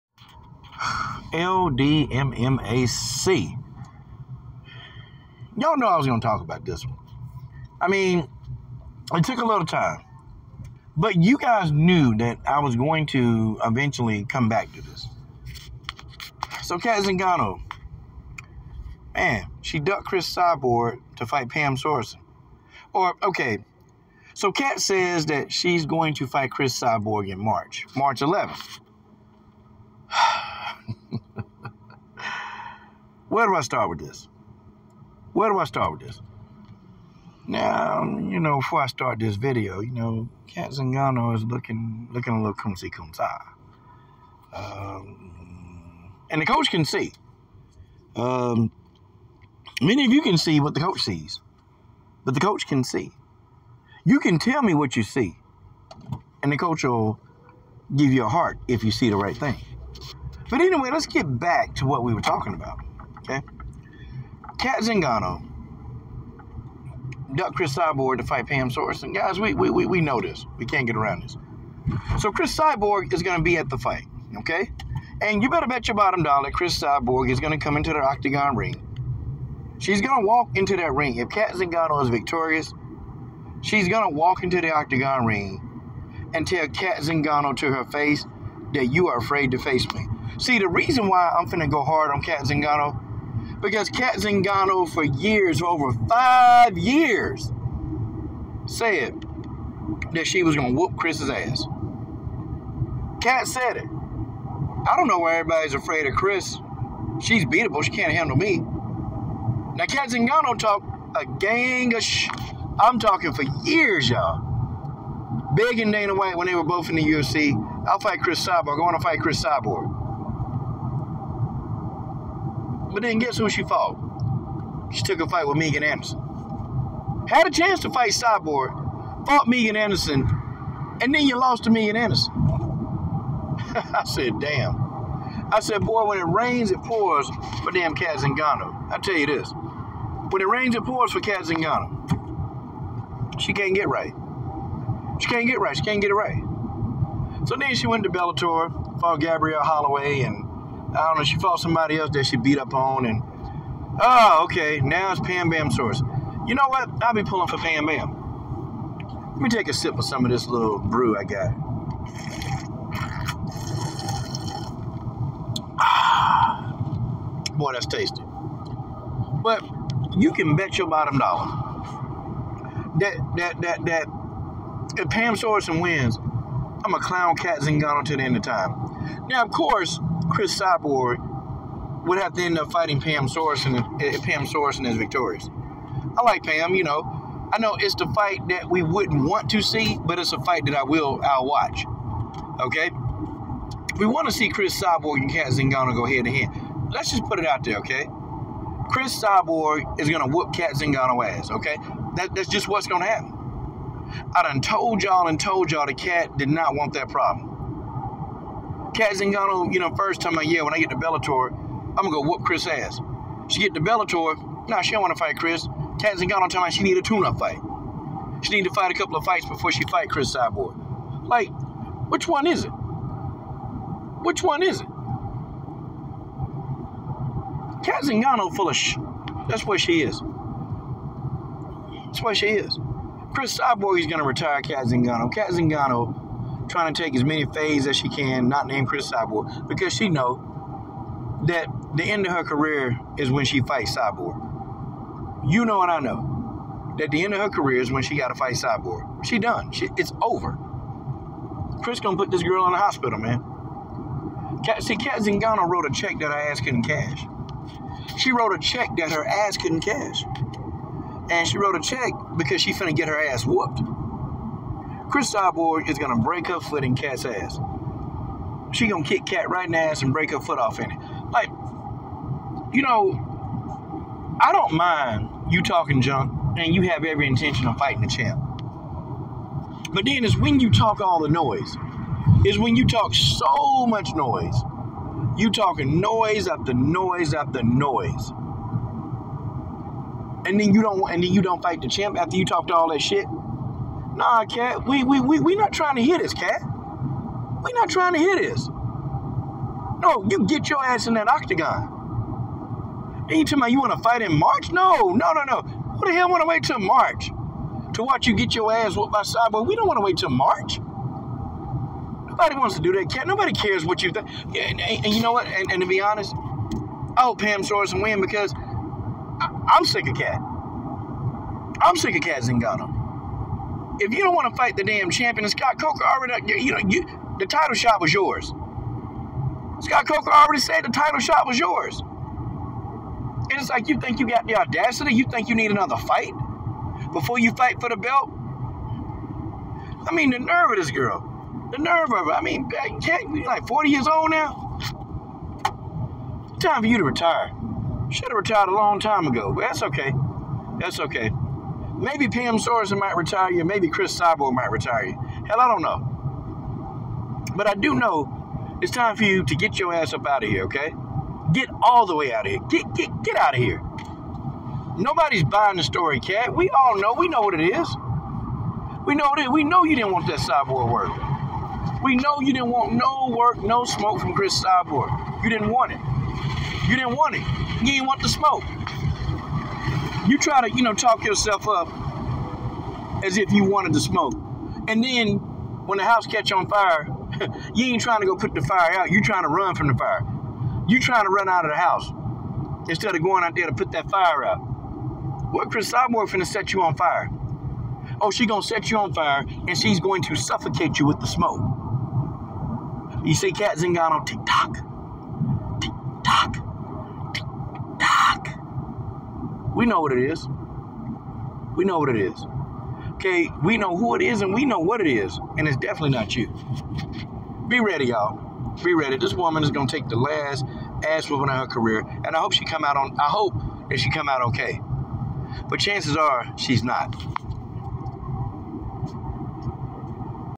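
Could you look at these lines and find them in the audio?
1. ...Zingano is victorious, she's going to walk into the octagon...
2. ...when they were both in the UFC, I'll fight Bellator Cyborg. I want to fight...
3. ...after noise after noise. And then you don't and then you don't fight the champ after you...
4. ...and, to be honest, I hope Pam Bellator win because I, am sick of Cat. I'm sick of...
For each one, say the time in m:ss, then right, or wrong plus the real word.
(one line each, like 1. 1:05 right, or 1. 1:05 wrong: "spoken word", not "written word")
1. 1:21 right
2. 1:56 wrong: "Cris", not "Bellator"
3. 4:46 right
4. 5:15 wrong: "Sorenson", not "Bellator".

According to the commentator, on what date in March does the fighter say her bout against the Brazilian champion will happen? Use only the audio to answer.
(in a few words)
March 11th.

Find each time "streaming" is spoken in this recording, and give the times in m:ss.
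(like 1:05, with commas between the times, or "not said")
not said.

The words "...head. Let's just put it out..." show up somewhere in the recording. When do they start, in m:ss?
3:16.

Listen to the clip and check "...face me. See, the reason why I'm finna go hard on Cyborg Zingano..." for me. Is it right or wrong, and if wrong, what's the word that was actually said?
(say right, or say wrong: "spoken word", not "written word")
wrong: "Cat", not "Cyborg".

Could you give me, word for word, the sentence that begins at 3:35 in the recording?
Cat Zingano tell me she need a tune-up fight.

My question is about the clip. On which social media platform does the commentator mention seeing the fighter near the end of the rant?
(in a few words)
TikTok.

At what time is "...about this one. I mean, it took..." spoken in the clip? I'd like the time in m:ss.
0:06.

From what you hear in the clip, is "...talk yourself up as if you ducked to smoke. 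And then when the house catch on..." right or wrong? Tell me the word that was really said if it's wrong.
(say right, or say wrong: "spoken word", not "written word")
wrong: "wanted", not "ducked".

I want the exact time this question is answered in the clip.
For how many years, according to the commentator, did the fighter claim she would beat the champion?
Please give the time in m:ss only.
1:36.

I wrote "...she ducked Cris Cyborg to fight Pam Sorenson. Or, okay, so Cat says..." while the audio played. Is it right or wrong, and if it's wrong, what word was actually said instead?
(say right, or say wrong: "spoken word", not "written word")
right.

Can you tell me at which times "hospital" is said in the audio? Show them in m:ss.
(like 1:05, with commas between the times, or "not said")
4:12.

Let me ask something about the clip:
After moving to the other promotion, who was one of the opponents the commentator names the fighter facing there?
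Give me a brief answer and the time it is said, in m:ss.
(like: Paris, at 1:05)
Gabrielle Holloway, at 2:29.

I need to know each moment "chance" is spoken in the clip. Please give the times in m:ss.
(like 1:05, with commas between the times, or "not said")
2:07, 7:05.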